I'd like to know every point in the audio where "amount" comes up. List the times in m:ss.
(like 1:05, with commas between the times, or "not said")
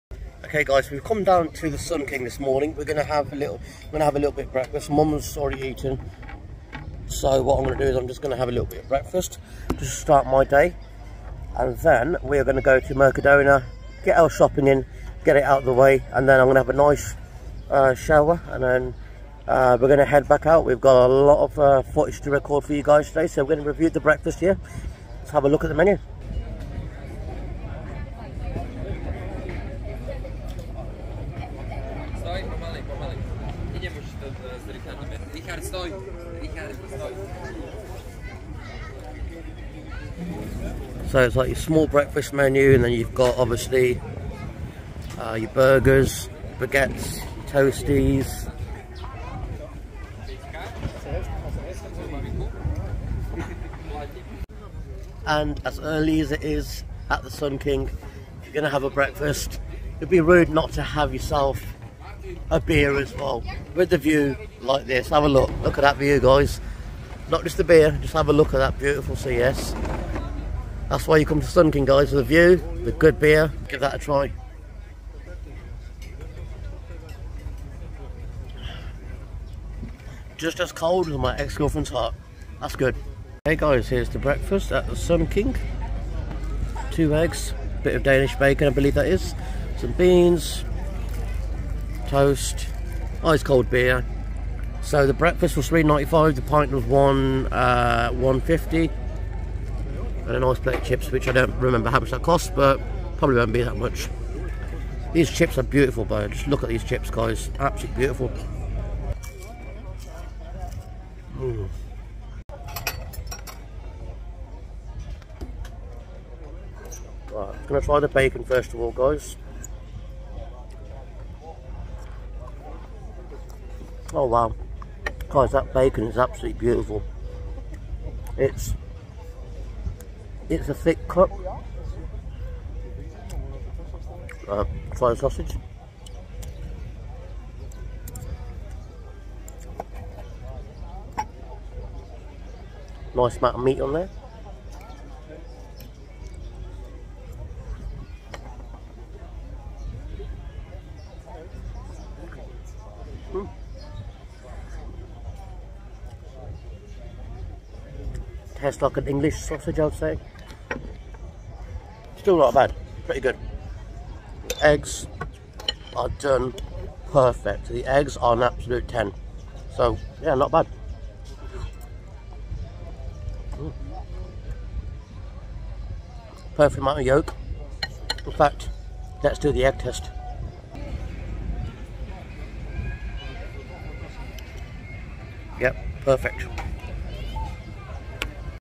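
2:23, 2:56.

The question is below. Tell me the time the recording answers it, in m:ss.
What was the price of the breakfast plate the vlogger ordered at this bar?
1:35.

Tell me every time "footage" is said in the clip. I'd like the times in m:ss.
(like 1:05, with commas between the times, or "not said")
0:21.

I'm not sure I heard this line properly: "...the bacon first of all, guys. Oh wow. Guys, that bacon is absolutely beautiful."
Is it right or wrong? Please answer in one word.
right.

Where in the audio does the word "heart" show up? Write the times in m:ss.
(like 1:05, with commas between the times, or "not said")
1:21.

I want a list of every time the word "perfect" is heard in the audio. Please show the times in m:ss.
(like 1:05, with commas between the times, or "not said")
2:47, 2:56, 3:06.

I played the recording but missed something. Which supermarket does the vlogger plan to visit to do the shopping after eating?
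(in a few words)
Mercadona.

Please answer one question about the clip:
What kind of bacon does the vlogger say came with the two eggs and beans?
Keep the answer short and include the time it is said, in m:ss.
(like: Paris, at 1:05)
Danish bacon, at 1:28.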